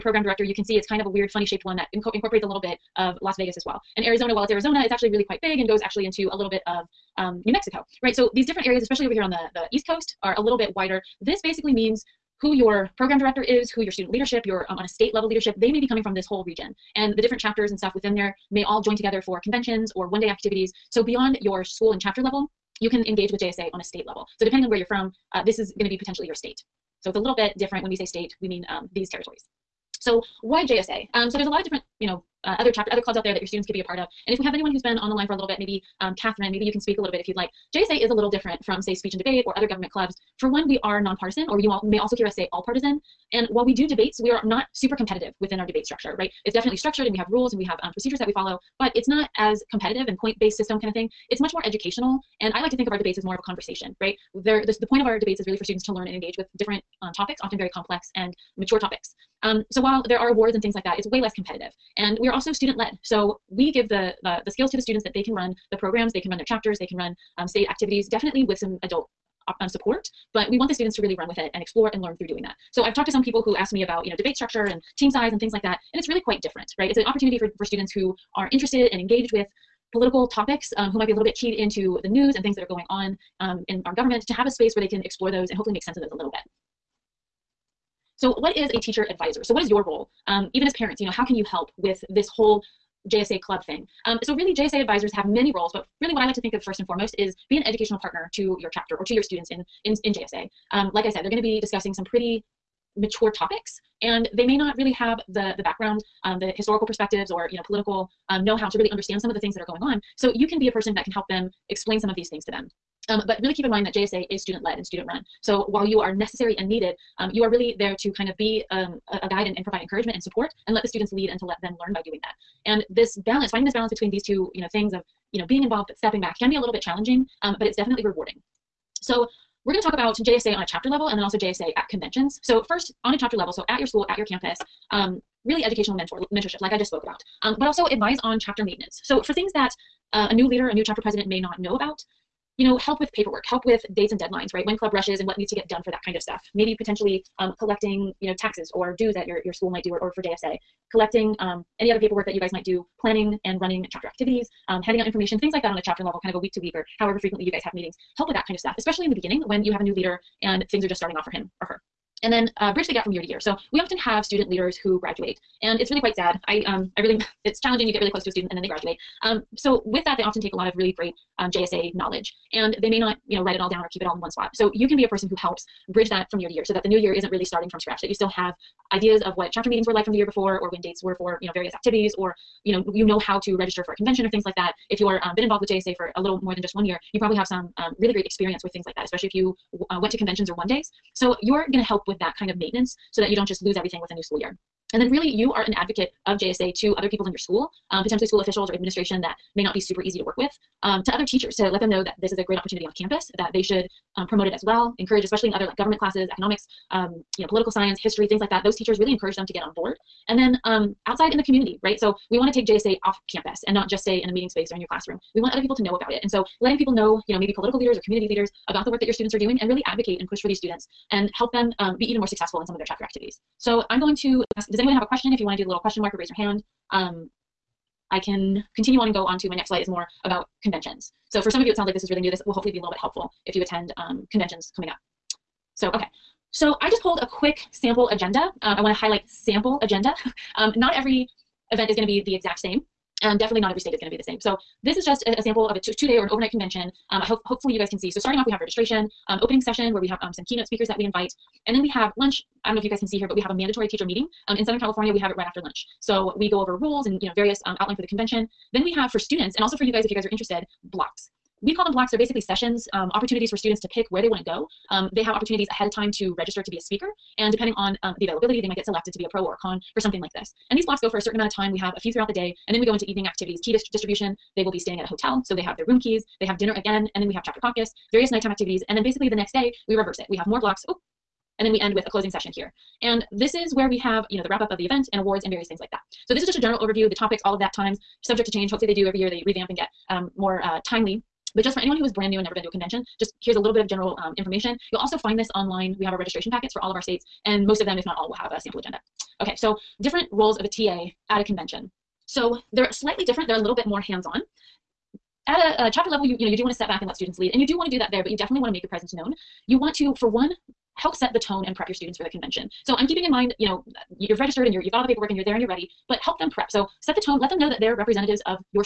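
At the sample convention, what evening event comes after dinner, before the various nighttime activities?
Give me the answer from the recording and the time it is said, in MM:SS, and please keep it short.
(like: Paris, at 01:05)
chapter caucus, at 04:37.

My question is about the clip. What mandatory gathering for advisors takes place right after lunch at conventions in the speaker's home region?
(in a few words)
mandatory teacher meeting.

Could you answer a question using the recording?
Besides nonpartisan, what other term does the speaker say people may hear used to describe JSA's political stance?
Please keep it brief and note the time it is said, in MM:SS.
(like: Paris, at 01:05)
all partisan, at 00:42.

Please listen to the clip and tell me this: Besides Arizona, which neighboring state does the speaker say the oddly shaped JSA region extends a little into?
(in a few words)
New Mexico.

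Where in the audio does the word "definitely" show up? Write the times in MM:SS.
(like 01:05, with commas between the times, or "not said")
00:46, 01:08, 02:07, 04:03, 05:08.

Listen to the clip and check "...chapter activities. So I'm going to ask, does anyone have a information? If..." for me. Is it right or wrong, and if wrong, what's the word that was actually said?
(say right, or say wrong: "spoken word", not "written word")
wrong: "question", not "information".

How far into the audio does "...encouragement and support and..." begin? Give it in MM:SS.
01:59.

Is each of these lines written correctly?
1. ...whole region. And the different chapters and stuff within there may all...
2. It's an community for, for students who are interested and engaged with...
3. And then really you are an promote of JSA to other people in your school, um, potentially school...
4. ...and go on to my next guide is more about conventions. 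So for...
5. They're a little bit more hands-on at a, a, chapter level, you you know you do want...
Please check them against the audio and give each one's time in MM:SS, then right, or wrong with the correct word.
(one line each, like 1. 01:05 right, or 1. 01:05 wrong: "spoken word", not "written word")
1. 00:16 right
2. 01:16 wrong: "opportunity", not "community"
3. 03:14 wrong: "advocate", not "promote"
4. 03:49 wrong: "slide", not "guide"
5. 05:03 right.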